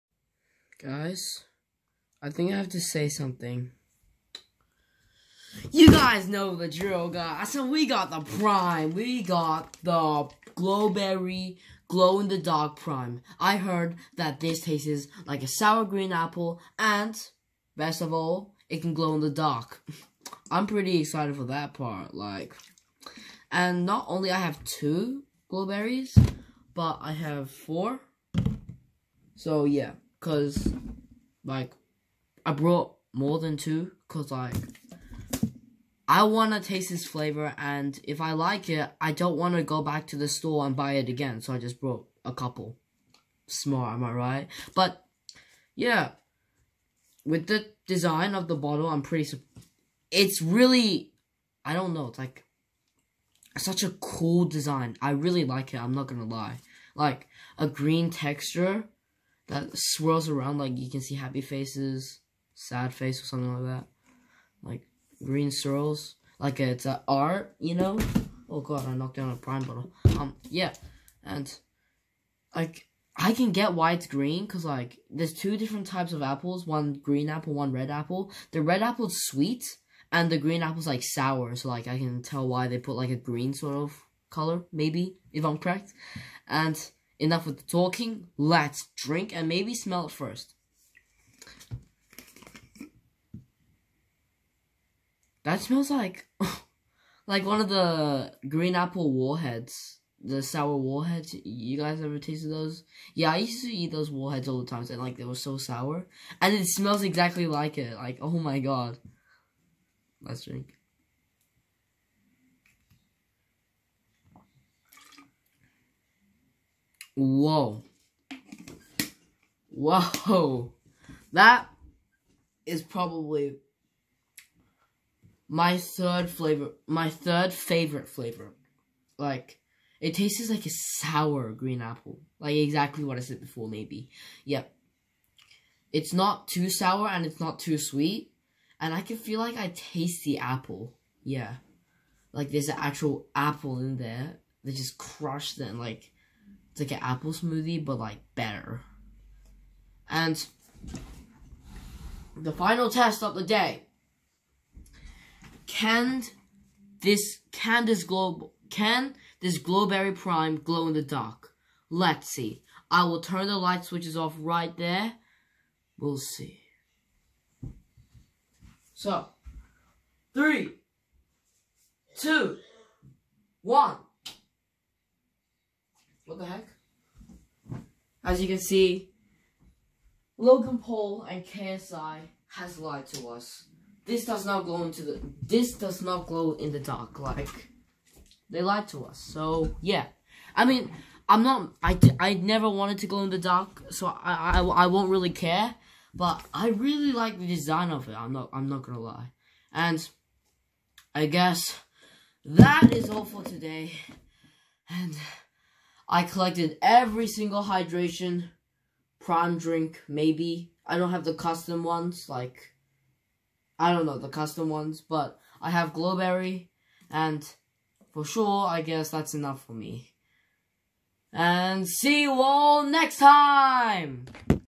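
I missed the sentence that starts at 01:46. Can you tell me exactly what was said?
And it smells exactly like it.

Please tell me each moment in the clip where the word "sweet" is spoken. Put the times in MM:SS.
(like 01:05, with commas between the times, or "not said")
01:19, 02:17.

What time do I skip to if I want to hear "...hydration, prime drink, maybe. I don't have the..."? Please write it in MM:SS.
03:27.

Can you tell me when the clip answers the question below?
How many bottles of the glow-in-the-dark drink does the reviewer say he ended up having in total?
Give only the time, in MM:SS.
00:27.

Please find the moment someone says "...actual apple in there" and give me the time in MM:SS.
02:22.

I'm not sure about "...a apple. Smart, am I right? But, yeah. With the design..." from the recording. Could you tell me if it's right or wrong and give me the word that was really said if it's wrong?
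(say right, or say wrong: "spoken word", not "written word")
wrong: "couple", not "apple".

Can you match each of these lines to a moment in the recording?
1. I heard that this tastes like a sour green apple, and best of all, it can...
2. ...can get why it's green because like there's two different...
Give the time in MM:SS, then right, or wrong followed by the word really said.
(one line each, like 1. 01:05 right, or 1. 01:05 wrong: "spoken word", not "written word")
1. 00:13 right
2. 01:13 right.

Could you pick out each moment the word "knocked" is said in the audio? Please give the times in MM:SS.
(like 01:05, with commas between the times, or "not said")
01:08.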